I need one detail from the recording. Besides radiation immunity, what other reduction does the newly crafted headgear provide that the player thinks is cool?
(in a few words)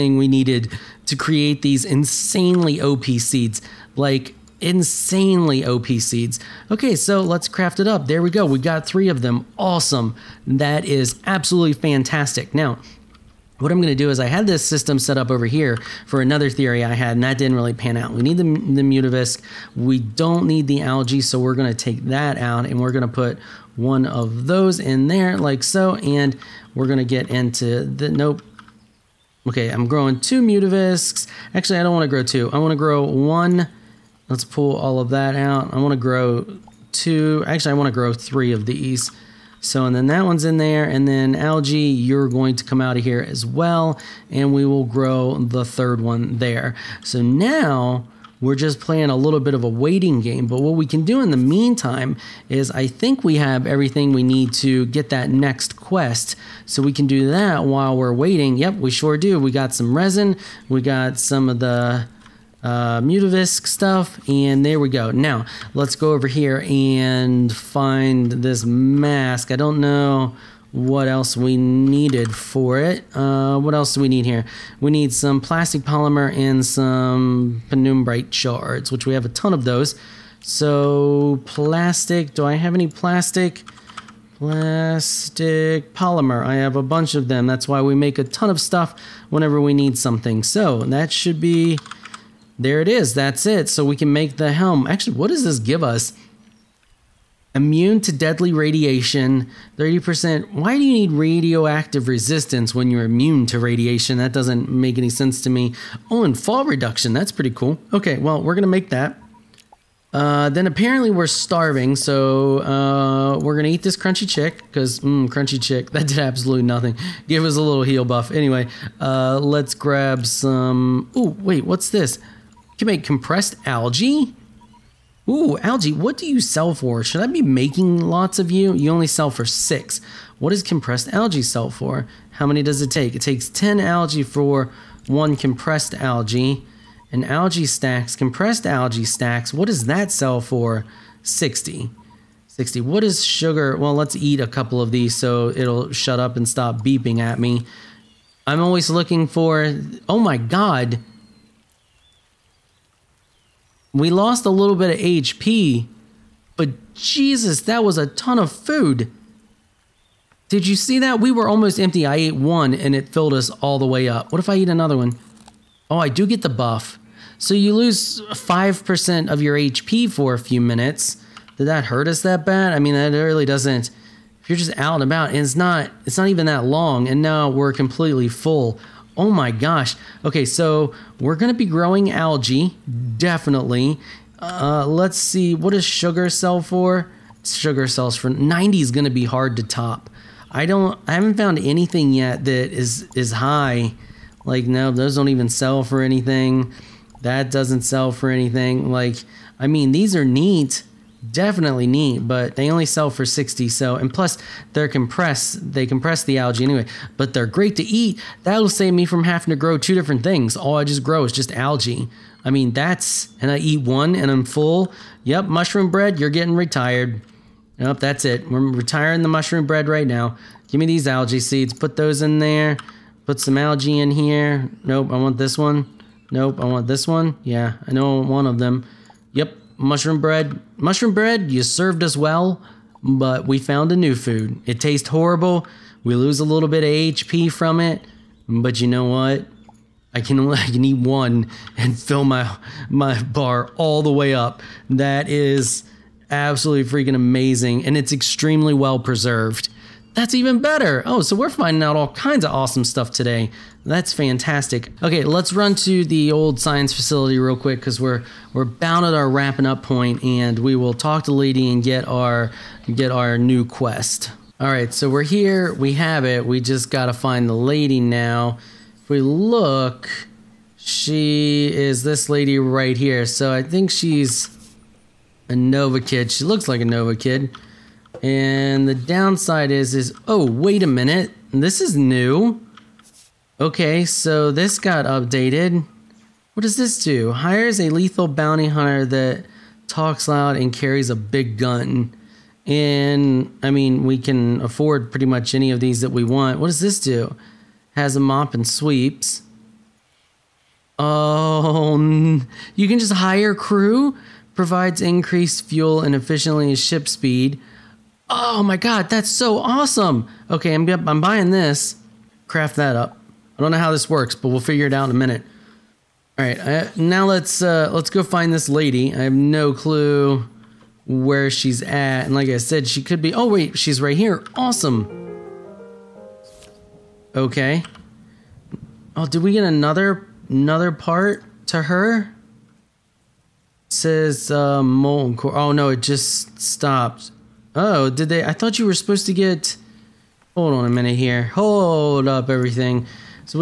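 fall reduction.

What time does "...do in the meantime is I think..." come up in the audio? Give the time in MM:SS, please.
00:51.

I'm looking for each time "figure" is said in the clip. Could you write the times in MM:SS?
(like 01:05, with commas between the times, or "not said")
05:14.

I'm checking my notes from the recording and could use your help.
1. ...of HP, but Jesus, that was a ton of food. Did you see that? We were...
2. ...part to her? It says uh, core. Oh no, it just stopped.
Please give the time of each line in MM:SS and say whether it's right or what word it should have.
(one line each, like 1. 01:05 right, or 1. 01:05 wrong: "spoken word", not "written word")
1. 02:34 right
2. 05:30 right.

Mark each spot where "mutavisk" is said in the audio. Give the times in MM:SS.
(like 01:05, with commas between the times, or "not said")
00:18, 00:30, 01:02.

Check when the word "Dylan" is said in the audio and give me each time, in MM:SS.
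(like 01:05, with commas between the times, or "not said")
not said.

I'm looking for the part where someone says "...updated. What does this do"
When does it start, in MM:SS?
04:45.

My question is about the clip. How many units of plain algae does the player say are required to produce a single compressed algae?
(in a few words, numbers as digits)
10.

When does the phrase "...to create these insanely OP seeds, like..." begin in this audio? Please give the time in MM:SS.
00:01.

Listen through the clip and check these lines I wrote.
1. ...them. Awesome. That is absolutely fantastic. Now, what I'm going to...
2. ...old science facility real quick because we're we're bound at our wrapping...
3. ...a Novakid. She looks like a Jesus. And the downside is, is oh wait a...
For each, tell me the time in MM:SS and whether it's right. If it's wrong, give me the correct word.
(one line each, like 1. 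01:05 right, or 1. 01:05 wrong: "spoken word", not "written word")
1. 00:09 right
2. 04:16 right
3. 04:35 wrong: "Novakid", not "Jesus".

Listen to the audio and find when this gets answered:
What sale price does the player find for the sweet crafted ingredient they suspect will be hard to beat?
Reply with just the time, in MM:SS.
03:08.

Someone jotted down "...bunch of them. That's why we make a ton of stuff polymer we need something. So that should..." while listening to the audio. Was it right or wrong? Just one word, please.
wrong.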